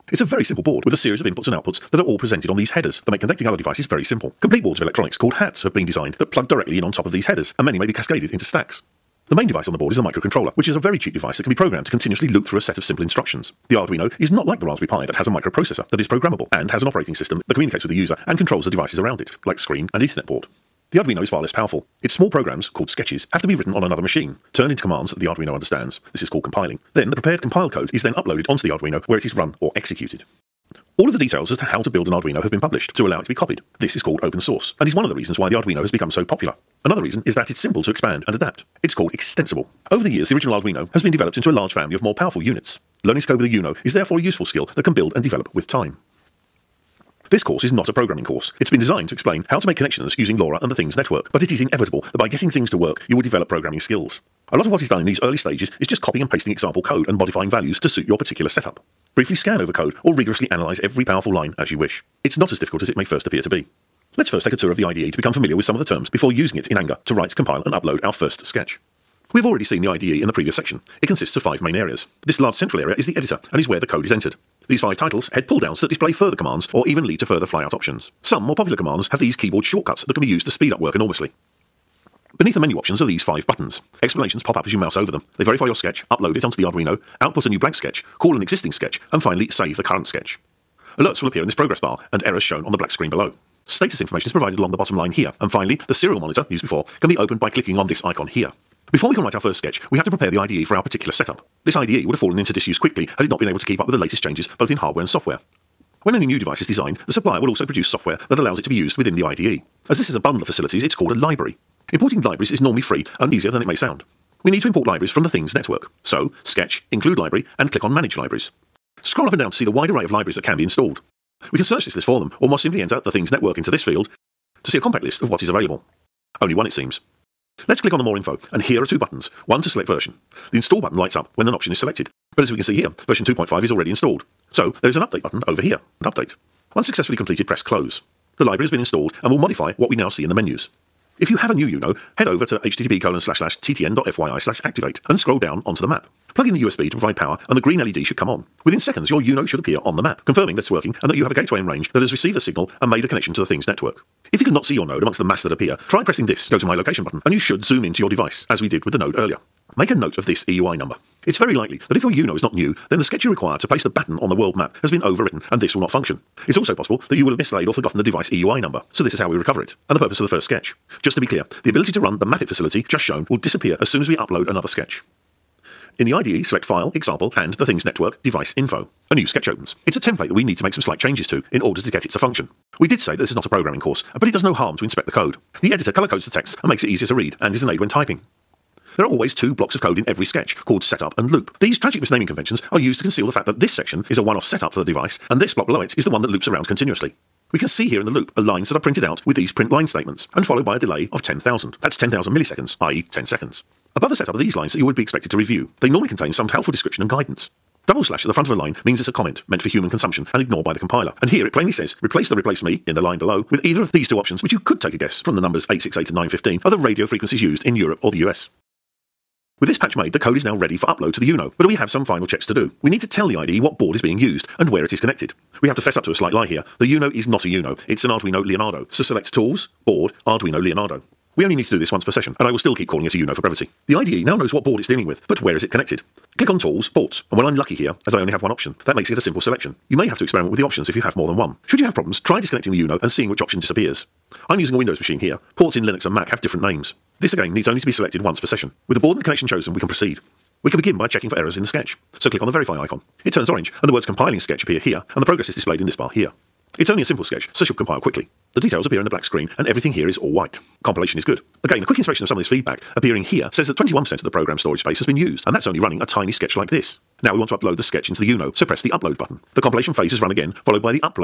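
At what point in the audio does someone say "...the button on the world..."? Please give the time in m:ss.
2:43.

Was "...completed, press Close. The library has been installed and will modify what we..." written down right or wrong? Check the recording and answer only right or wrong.
right.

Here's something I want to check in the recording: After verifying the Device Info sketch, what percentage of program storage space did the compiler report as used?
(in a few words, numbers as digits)
21%.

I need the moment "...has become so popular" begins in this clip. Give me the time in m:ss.
0:35.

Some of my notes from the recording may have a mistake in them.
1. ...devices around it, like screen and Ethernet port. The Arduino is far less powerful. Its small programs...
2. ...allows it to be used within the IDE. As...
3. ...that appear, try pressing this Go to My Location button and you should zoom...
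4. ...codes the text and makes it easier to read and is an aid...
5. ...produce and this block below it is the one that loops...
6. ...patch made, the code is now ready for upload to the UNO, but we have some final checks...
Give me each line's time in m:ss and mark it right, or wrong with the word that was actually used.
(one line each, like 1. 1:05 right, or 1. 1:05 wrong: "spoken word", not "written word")
1. 0:18 right
2. 1:48 right
3. 2:35 right
4. 3:06 right
5. 3:14 wrong: "device", not "produce"
6. 3:39 right.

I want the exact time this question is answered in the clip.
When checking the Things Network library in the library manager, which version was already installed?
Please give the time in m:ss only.
2:13.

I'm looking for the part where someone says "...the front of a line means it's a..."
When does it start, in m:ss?
3:28.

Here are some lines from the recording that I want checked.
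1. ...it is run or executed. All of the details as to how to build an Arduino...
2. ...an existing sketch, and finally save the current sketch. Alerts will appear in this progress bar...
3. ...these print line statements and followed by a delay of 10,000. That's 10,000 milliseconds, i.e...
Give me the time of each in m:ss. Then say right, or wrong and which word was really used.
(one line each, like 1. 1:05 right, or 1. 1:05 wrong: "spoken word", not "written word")
1. 0:29 right
2. 1:28 right
3. 3:19 right.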